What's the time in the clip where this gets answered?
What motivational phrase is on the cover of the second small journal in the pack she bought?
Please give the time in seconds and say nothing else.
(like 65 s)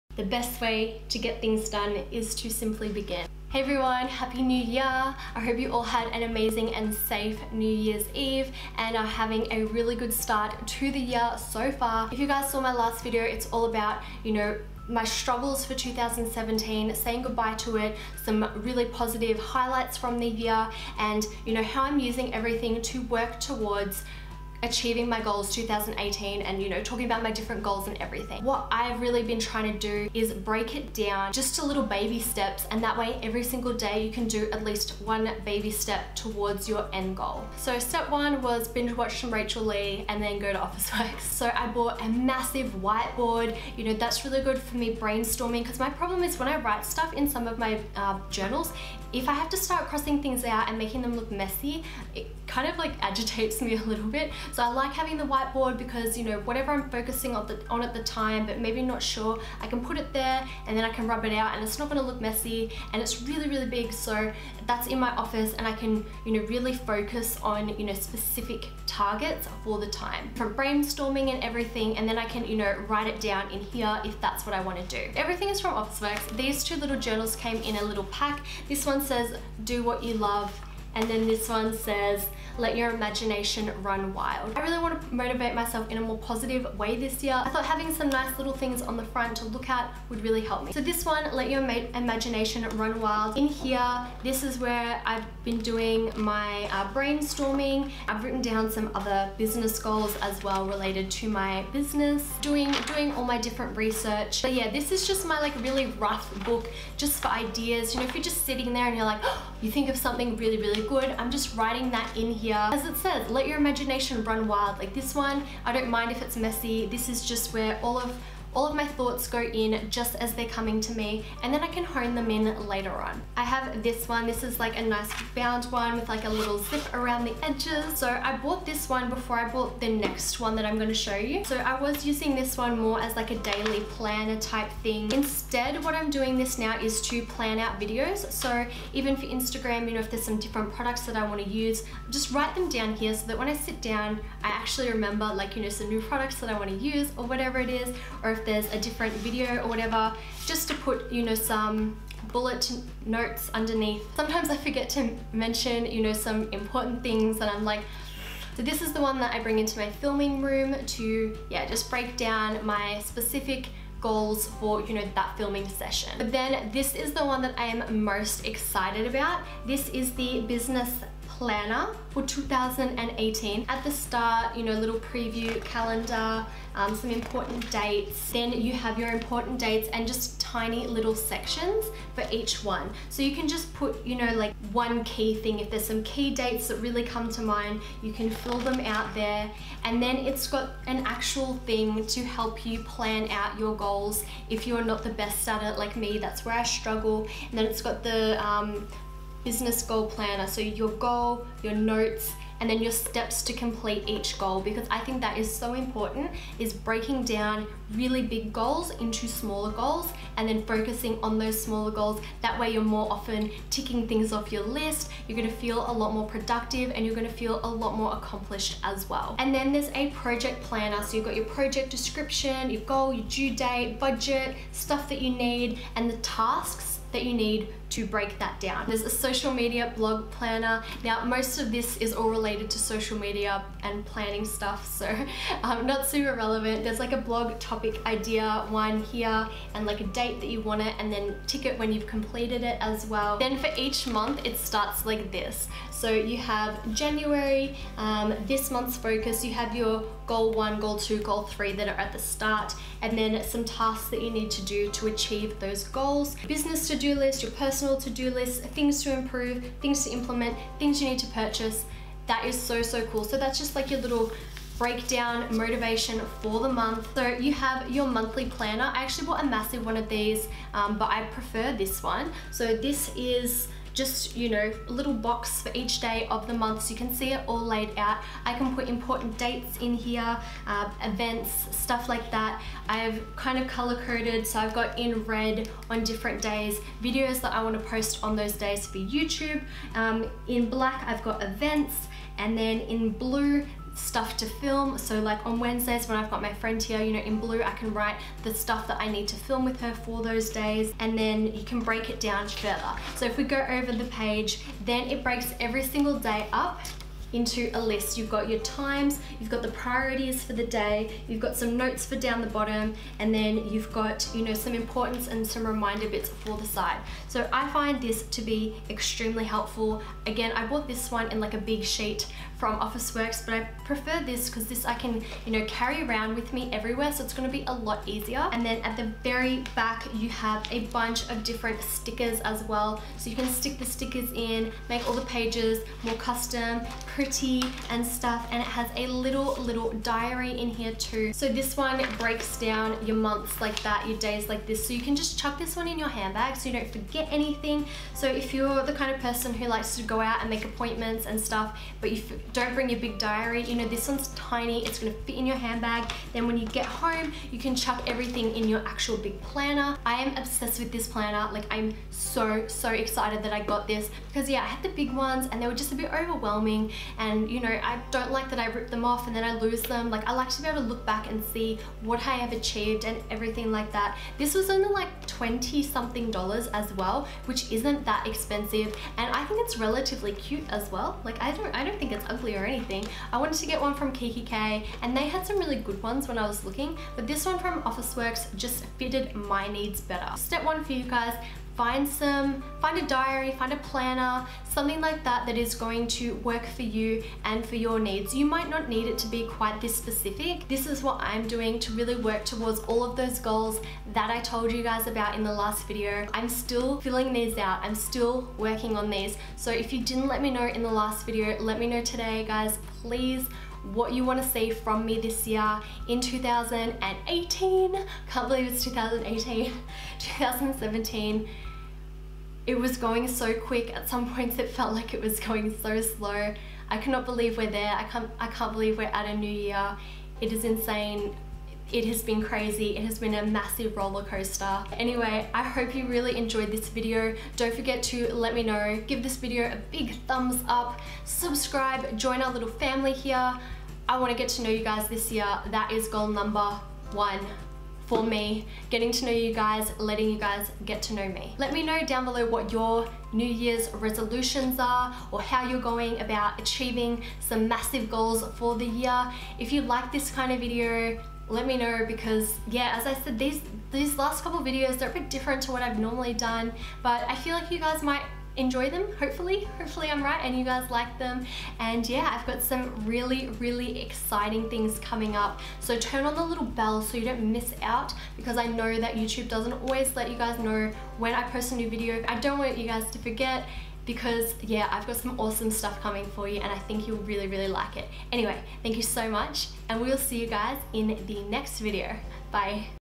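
79 s.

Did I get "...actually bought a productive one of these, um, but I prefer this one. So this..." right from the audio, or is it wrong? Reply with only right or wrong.
wrong.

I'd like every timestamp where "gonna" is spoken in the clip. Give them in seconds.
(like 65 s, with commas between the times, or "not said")
61 s, 327 s, 354 s.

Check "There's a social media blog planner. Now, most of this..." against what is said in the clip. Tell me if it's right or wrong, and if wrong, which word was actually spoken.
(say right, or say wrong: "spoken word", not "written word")
right.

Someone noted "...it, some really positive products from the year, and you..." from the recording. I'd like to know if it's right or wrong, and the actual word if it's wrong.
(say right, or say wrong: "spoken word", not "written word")
wrong: "highlights", not "products".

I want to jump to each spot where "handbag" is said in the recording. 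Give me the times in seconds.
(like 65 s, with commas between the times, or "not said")
346 s, 355 s.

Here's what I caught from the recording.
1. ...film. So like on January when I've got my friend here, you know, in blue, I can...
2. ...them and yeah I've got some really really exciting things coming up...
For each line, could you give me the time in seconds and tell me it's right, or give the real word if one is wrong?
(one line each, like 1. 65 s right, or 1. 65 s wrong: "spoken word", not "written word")
1. 294 s wrong: "Wednesdays", not "January"
2. 471 s right.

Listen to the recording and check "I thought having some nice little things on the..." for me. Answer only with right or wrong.
right.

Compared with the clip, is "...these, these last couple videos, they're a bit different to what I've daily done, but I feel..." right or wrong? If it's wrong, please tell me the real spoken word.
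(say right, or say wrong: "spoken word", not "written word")
wrong: "normally", not "daily".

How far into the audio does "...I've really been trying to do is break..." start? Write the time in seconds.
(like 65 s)
28 s.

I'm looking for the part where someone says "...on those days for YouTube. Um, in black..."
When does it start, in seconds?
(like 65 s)
288 s.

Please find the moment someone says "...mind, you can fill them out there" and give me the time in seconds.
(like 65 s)
187 s.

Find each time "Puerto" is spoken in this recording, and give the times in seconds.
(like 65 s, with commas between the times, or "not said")
not said.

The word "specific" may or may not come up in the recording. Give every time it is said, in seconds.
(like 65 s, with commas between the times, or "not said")
67 s, 163 s, 399 s.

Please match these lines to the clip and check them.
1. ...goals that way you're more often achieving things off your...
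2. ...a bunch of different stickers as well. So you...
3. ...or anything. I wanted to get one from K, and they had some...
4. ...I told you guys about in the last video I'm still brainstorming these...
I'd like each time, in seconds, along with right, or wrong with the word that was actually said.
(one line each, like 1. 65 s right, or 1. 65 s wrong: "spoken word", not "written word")
1. 211 s wrong: "ticking", not "achieving"
2. 330 s right
3. 382 s right
4. 404 s wrong: "filling", not "brainstorming".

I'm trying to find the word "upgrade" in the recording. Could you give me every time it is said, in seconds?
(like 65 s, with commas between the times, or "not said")
not said.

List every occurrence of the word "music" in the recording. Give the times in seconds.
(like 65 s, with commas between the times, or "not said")
not said.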